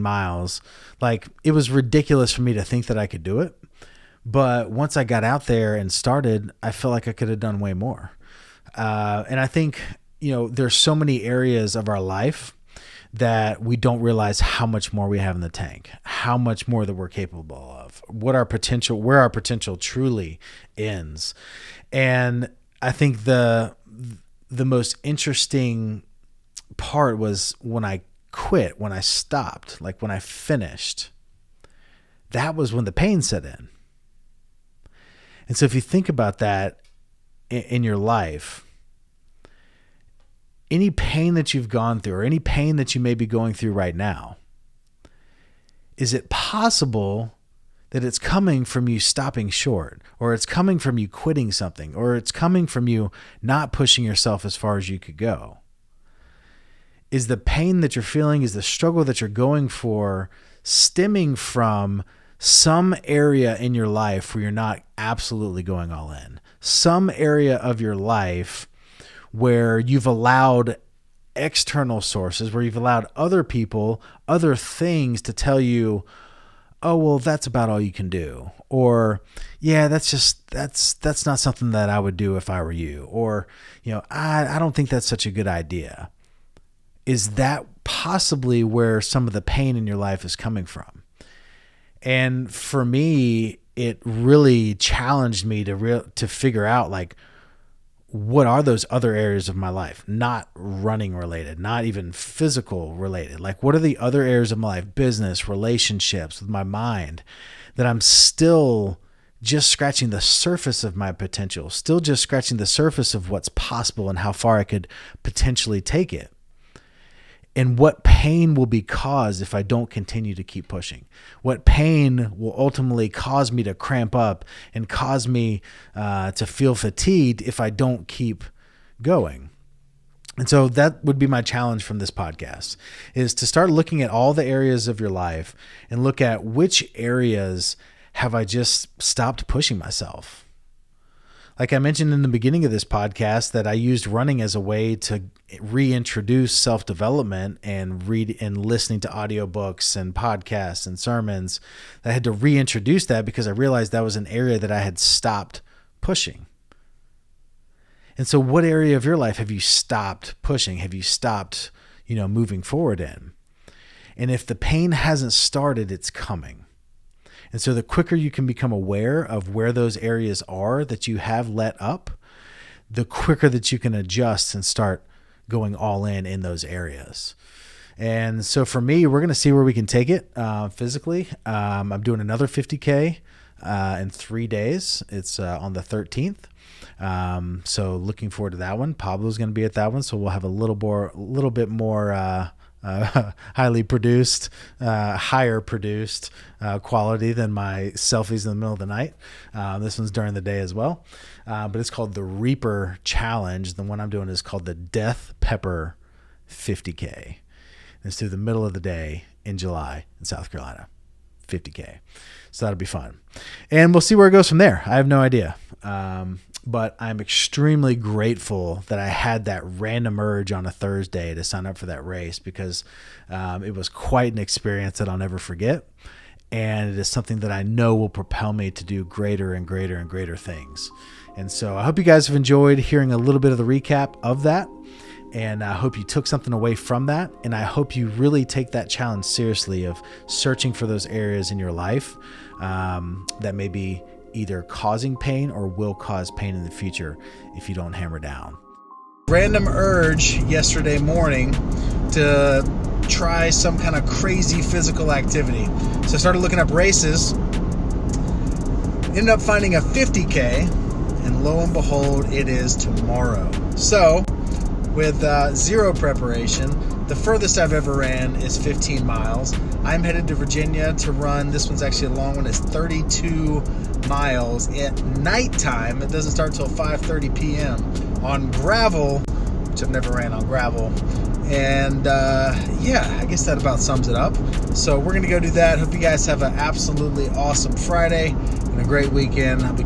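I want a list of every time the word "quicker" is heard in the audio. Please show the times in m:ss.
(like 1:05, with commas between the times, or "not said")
2:47, 2:53.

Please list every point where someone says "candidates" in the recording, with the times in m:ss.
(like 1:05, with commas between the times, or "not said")
not said.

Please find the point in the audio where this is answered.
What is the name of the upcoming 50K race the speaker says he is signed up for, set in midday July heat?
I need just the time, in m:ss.
3:24.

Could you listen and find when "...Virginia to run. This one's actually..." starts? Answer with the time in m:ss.
4:30.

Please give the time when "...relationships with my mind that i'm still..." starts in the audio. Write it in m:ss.
1:45.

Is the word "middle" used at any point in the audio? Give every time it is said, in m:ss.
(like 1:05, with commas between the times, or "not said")
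3:18, 3:28.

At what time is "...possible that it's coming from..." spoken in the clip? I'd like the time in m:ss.
0:46.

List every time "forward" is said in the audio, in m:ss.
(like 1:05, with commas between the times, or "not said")
2:42, 3:08.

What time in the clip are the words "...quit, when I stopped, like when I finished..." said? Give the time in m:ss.
0:28.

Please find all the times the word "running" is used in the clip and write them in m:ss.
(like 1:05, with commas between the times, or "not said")
1:40, 2:24.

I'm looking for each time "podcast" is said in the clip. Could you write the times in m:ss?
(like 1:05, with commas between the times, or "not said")
2:12, 2:22, 2:30.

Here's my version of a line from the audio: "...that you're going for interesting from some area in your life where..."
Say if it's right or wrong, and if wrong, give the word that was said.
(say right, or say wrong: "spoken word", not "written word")
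wrong: "stemming", not "interesting".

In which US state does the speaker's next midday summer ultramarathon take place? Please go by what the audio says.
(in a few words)
South Carolina.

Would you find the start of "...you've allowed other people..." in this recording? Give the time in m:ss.
1:12.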